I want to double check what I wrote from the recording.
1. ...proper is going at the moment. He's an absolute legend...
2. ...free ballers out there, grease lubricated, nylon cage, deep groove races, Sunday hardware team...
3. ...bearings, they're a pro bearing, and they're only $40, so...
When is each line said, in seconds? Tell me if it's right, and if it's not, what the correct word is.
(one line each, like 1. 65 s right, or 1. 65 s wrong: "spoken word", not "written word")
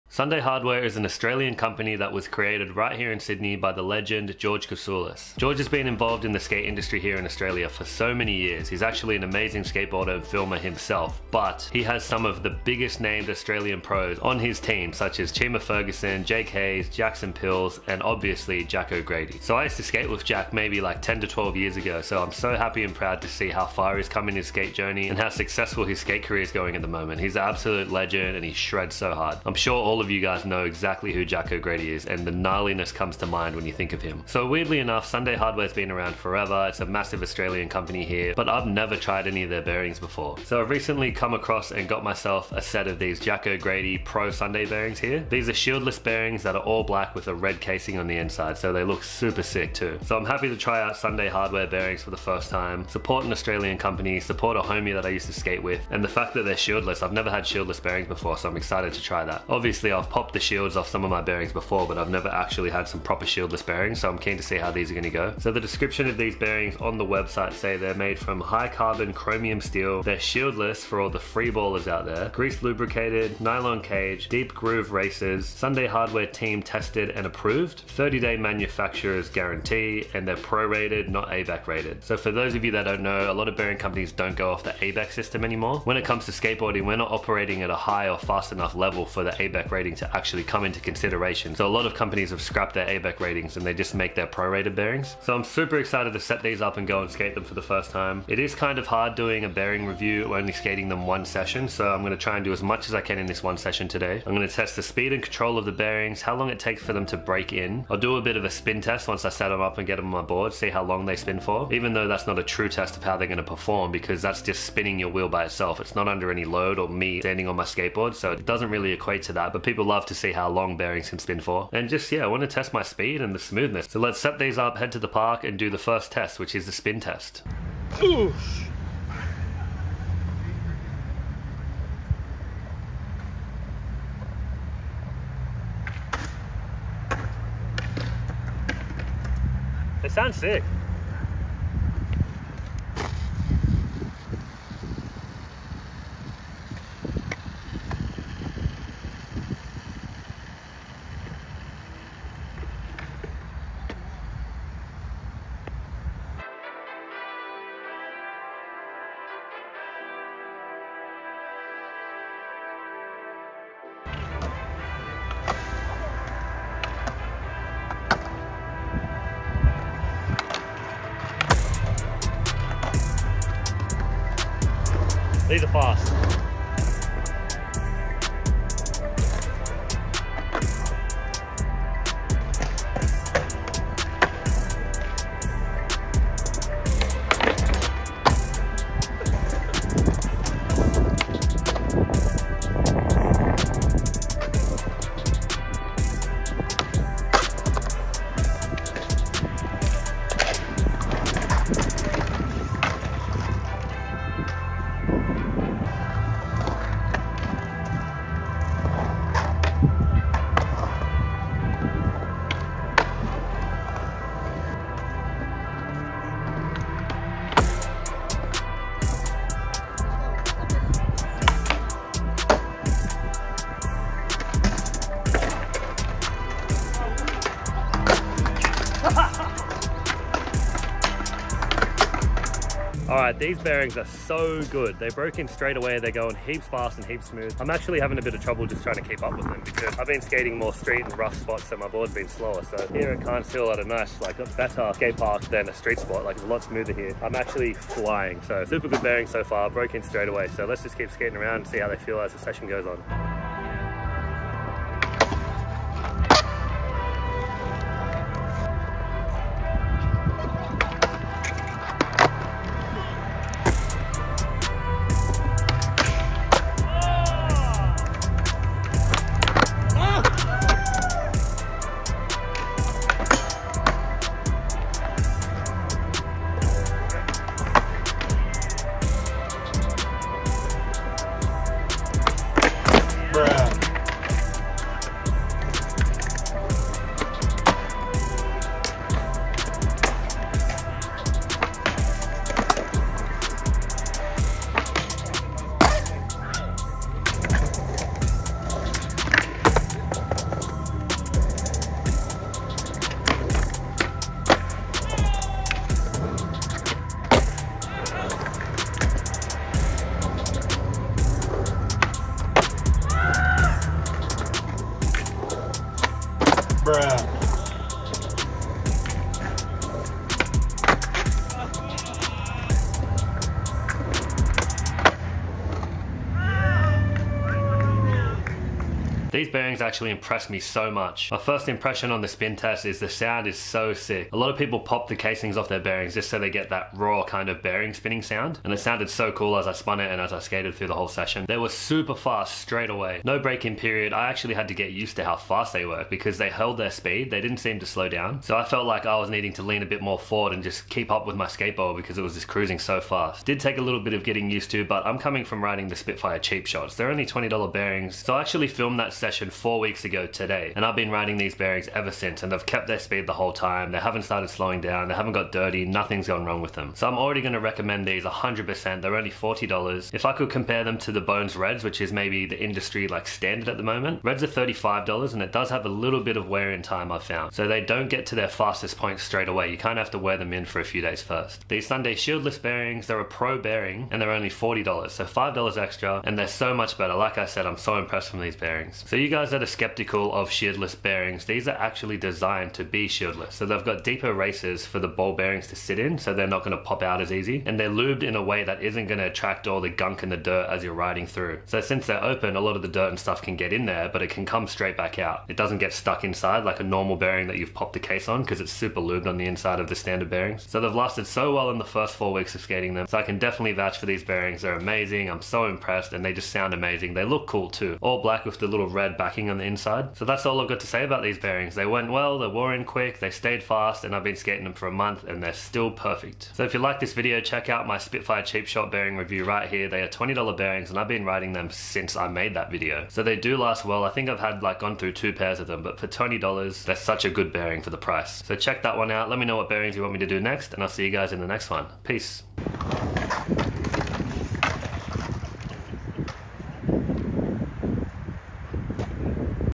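1. 26 s wrong: "career", not "proper"
2. 71 s right
3. 382 s right.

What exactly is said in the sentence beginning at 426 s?
So if you like this video, check out my Spitfire Cheap Shot bearing review right here.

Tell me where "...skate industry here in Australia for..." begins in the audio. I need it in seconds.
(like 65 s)
6 s.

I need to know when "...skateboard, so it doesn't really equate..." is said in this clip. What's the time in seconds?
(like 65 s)
117 s.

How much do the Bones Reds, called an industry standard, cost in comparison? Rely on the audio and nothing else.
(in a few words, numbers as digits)
$35.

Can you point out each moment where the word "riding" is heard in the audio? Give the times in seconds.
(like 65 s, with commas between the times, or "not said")
355 s, 361 s, 400 s, 431 s.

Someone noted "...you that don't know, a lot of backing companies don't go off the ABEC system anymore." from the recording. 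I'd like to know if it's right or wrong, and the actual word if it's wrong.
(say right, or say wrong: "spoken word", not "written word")
wrong: "bearing", not "backing".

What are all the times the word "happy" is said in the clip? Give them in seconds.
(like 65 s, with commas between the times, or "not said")
22 s, 50 s.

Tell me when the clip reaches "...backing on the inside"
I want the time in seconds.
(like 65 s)
419 s.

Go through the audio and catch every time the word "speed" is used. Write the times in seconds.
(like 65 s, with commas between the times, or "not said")
104 s, 122 s, 346 s, 362 s.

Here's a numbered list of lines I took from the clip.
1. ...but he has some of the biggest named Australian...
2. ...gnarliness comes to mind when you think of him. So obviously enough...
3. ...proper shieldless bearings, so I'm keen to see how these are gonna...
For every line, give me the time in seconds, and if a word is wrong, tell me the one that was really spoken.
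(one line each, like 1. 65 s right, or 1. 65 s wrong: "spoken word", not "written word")
1. 11 s right
2. 32 s wrong: "weirdly", not "obviously"
3. 62 s right.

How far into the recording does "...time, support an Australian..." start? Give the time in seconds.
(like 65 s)
52 s.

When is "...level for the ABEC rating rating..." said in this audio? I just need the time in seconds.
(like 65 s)
88 s.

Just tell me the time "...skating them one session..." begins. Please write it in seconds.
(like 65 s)
100 s.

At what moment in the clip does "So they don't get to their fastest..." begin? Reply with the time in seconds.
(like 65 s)
377 s.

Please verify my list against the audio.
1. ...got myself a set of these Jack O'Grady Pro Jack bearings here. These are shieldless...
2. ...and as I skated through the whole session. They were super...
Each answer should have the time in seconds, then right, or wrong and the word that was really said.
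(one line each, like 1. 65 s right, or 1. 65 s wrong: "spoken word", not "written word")
1. 41 s wrong: "Sunday", not "Jack"
2. 340 s right.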